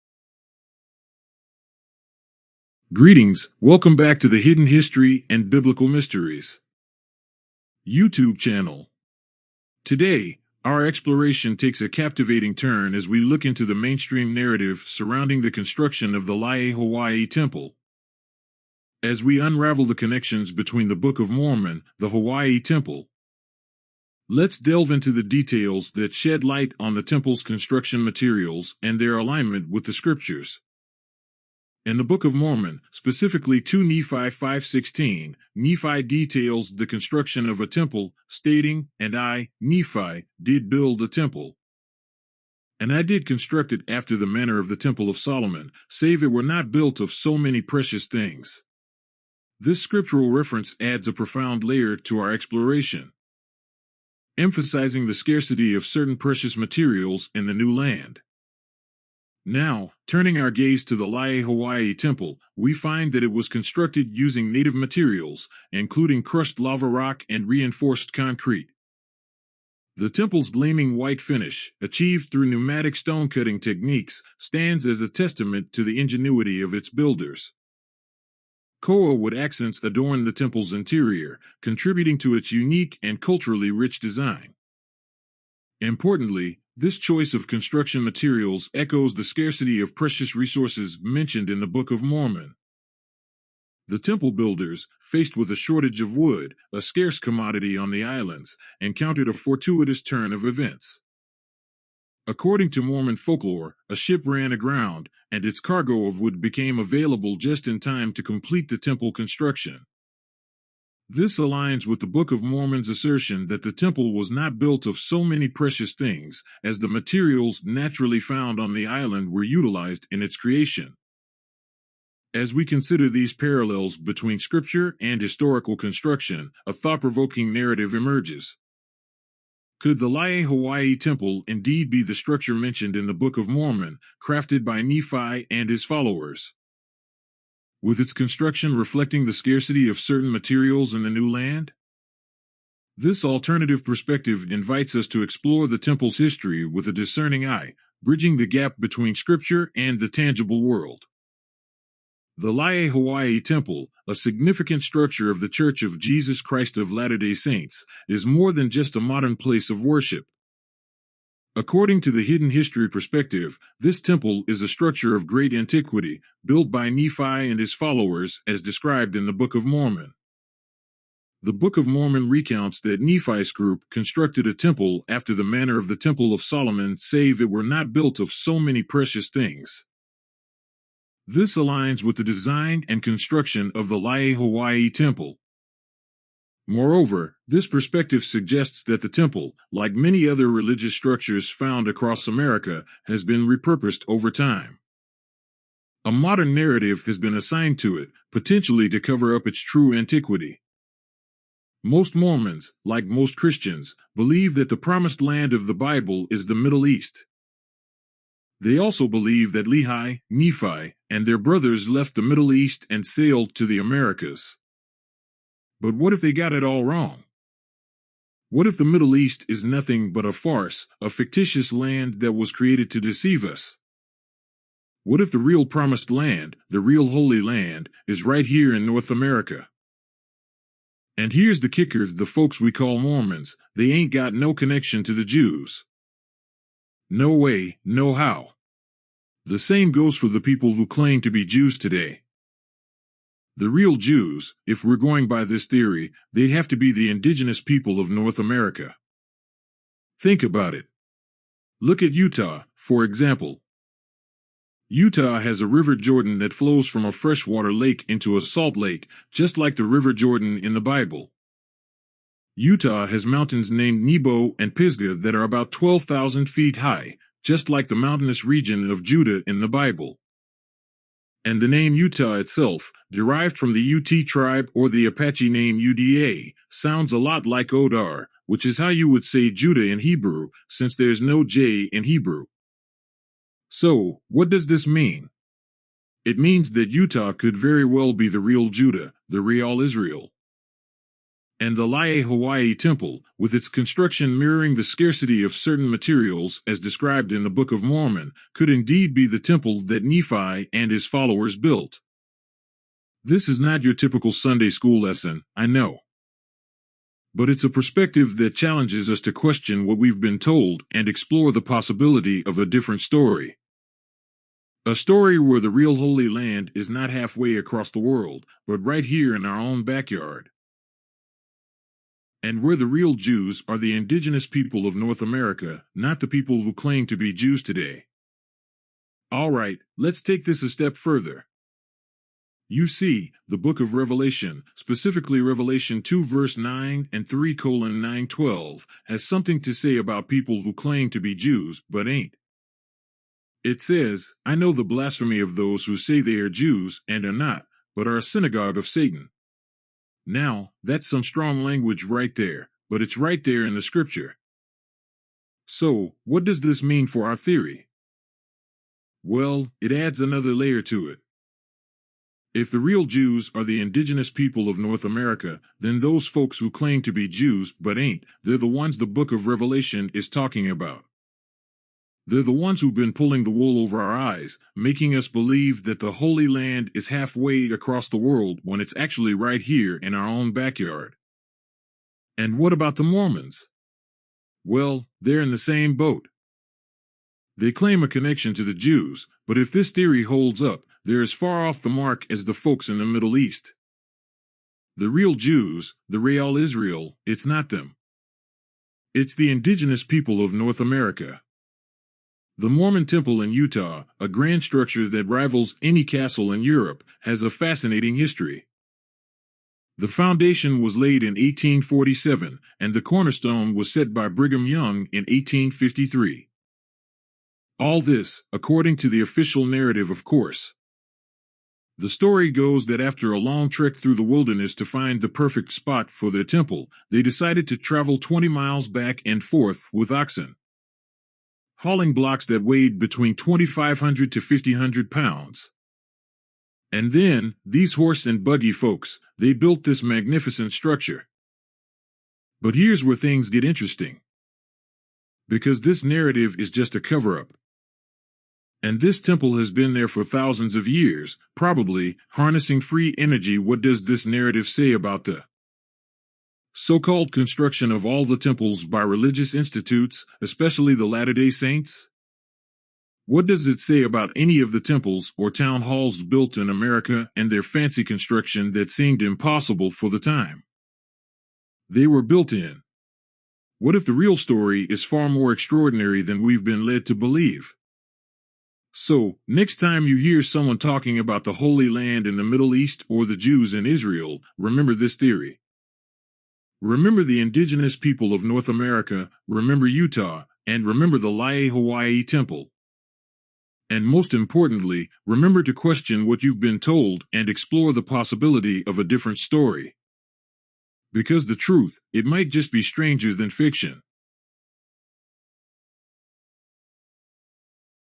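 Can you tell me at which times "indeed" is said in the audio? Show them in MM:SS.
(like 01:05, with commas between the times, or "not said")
02:11, 04:58.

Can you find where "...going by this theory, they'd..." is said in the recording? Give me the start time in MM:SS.
04:04.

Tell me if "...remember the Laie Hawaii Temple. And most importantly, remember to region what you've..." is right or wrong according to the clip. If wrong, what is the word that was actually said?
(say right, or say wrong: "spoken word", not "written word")
wrong: "question", not "region".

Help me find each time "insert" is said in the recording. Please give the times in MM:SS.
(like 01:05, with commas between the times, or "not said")
not said.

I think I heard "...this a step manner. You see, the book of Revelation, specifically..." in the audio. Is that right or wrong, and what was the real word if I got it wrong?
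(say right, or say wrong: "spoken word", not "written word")
wrong: "further", not "manner".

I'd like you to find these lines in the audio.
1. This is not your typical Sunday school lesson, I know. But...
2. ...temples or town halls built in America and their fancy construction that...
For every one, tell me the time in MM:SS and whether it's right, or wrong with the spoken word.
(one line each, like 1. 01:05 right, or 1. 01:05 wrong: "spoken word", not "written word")
1. 05:03 right
2. 07:44 right.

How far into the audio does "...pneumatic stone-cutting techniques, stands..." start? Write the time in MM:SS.
01:12.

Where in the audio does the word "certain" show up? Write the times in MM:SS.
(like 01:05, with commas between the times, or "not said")
00:55, 02:19, 04:55.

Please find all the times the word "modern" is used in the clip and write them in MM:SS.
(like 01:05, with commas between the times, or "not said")
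02:39, 03:16.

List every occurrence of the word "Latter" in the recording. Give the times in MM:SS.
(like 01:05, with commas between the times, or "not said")
02:36, 07:41.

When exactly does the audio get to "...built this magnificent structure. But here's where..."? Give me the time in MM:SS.
07:19.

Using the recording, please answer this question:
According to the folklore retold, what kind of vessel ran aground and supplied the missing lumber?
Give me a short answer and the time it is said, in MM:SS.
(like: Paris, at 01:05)
A ship, at 01:43.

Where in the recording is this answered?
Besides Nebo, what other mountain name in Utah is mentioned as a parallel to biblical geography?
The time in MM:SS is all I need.
04:24.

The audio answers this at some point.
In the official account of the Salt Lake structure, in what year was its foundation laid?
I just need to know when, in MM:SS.
06:51.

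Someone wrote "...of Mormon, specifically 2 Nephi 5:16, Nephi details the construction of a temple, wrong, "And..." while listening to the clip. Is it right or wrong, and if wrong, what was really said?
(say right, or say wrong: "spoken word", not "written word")
wrong: "stating", not "wrong".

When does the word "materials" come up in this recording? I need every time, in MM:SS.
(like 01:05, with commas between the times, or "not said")
00:28, 00:56, 01:04, 01:28, 01:56, 02:20, 04:55.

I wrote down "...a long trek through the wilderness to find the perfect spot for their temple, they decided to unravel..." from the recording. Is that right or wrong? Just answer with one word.
wrong.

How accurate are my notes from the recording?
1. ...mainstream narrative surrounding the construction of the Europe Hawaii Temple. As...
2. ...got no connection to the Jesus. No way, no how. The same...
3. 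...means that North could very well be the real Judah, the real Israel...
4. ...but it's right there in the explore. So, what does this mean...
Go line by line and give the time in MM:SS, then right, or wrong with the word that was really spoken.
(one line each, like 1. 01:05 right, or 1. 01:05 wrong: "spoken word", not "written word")
1. 00:13 wrong: "Laie", not "Europe"
2. 03:54 wrong: "Jews", not "Jesus"
3. 04:46 wrong: "Utah", not "North"
4. 05:52 wrong: "scripture", not "explore".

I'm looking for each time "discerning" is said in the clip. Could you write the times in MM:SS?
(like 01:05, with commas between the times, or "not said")
02:26.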